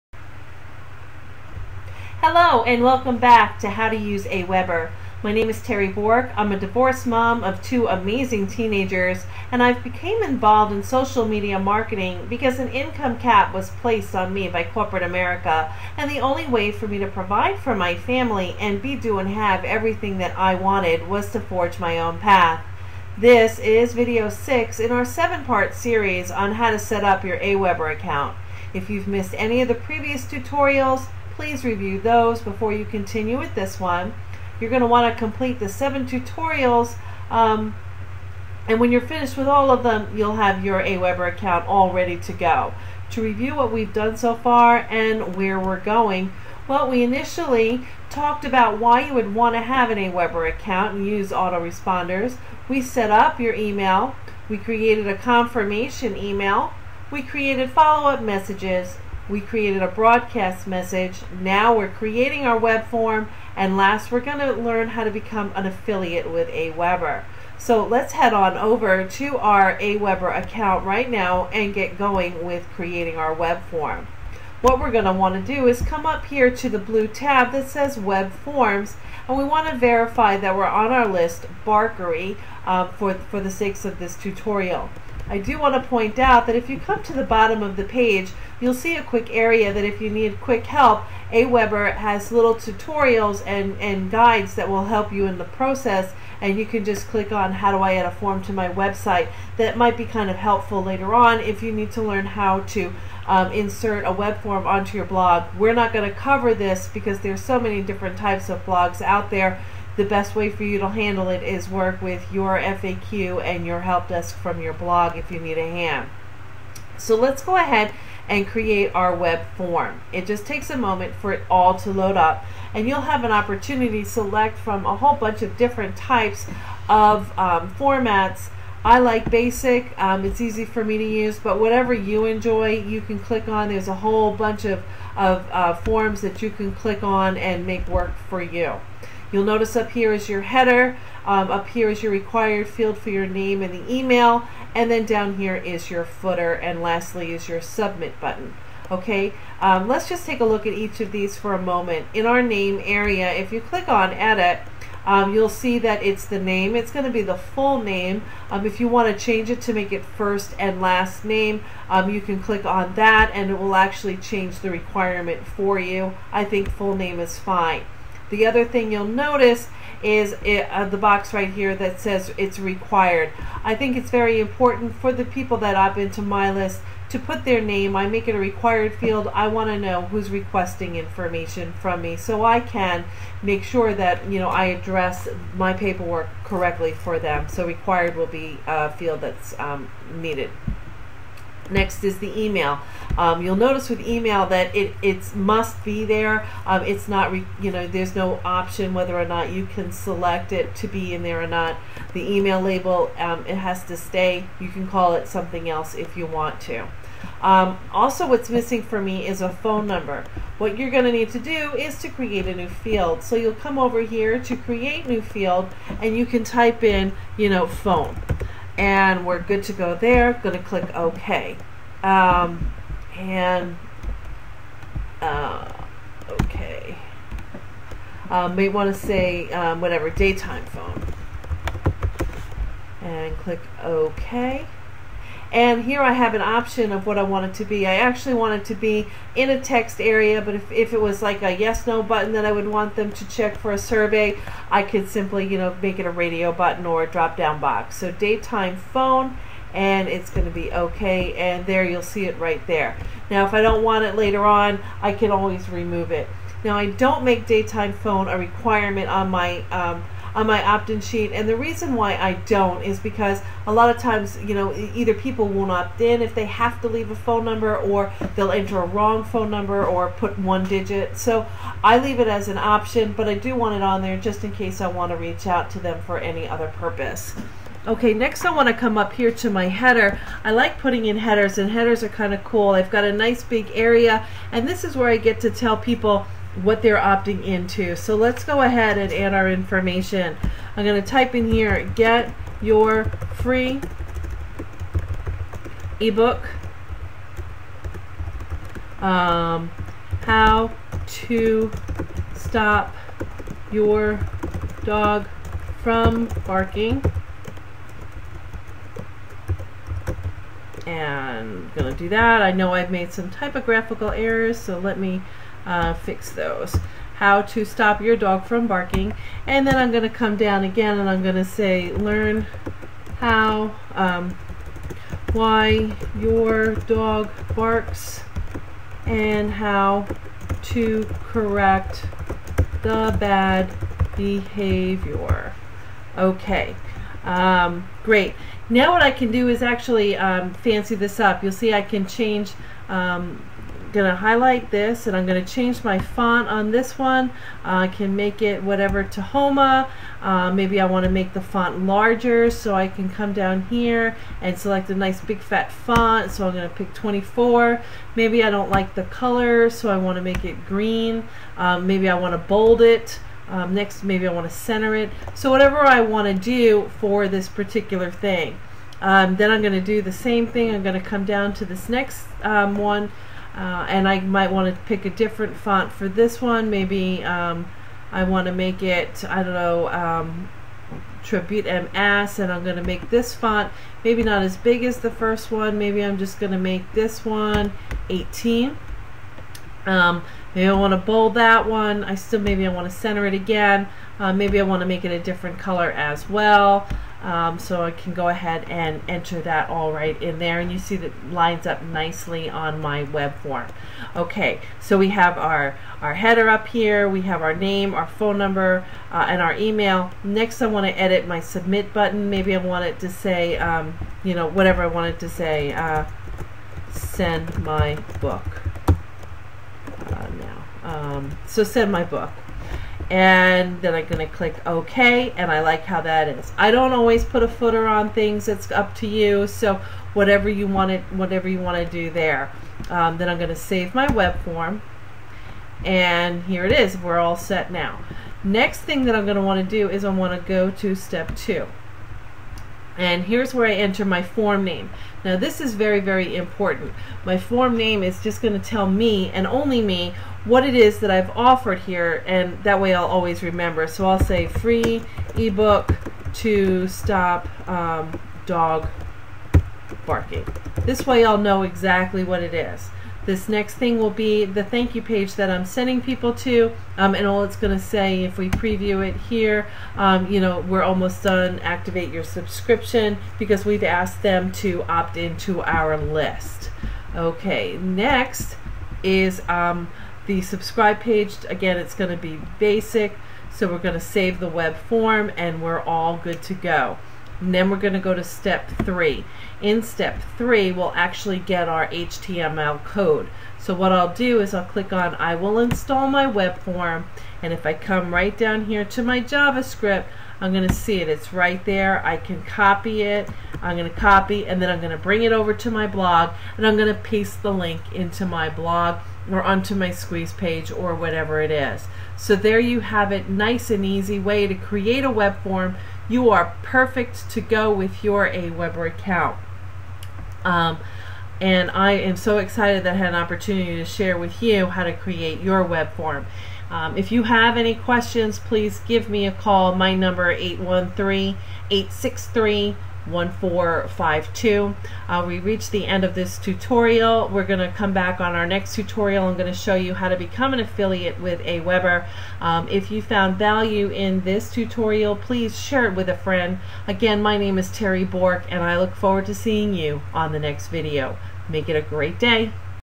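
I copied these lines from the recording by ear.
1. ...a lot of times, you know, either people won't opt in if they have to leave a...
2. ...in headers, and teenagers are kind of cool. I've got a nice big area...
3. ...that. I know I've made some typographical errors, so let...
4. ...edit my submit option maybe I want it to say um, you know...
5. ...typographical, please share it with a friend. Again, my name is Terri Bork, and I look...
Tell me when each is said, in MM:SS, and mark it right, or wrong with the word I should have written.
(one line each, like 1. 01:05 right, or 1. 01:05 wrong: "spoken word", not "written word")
1. 04:23 right
2. 04:41 wrong: "headers", not "teenagers"
3. 05:12 right
4. 06:50 wrong: "button", not "option"
5. 09:04 wrong: "tutorial", not "typographical".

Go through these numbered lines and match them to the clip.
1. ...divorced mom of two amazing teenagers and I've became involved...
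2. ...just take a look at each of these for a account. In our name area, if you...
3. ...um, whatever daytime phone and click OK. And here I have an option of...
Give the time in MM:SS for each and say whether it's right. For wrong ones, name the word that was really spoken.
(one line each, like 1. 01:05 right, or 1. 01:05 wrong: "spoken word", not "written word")
1. 00:06 right
2. 02:30 wrong: "moment", not "account"
3. 03:49 right.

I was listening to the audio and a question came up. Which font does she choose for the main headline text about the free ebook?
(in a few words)
Tahoma.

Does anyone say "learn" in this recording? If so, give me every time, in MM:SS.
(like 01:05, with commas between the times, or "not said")
01:04, 01:42, 05:21.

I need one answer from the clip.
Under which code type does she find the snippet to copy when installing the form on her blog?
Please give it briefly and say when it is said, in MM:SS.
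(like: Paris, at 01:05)
JavaScript, at 08:19.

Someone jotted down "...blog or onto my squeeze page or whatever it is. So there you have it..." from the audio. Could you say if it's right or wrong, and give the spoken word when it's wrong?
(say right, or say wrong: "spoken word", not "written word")
right.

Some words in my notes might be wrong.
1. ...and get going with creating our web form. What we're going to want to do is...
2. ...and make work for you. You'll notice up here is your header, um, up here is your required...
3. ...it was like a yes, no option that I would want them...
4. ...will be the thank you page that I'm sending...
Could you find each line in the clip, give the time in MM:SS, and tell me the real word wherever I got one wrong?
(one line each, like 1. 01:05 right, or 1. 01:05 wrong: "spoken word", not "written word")
1. 01:11 right
2. 02:17 right
3. 04:00 wrong: "button", not "option"
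4. 07:43 right.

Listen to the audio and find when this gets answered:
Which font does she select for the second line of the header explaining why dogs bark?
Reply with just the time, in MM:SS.
06:21.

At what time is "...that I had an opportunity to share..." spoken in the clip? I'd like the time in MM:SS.
08:42.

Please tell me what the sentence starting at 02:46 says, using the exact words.
I think full name is fine.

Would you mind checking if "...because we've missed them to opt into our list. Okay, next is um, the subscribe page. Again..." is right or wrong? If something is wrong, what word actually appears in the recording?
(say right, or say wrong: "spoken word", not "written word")
wrong: "asked", not "missed".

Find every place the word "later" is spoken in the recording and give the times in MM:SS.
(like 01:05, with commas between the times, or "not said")
01:40, 04:14.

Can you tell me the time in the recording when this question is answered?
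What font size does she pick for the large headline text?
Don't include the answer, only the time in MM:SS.
05:56.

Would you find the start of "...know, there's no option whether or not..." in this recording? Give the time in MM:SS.
03:17.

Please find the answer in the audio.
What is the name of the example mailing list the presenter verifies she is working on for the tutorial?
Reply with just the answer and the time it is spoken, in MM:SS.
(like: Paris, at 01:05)
Barkery, at 01:21.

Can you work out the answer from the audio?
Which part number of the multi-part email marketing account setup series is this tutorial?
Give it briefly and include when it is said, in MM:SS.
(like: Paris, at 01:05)
6, at 00:23.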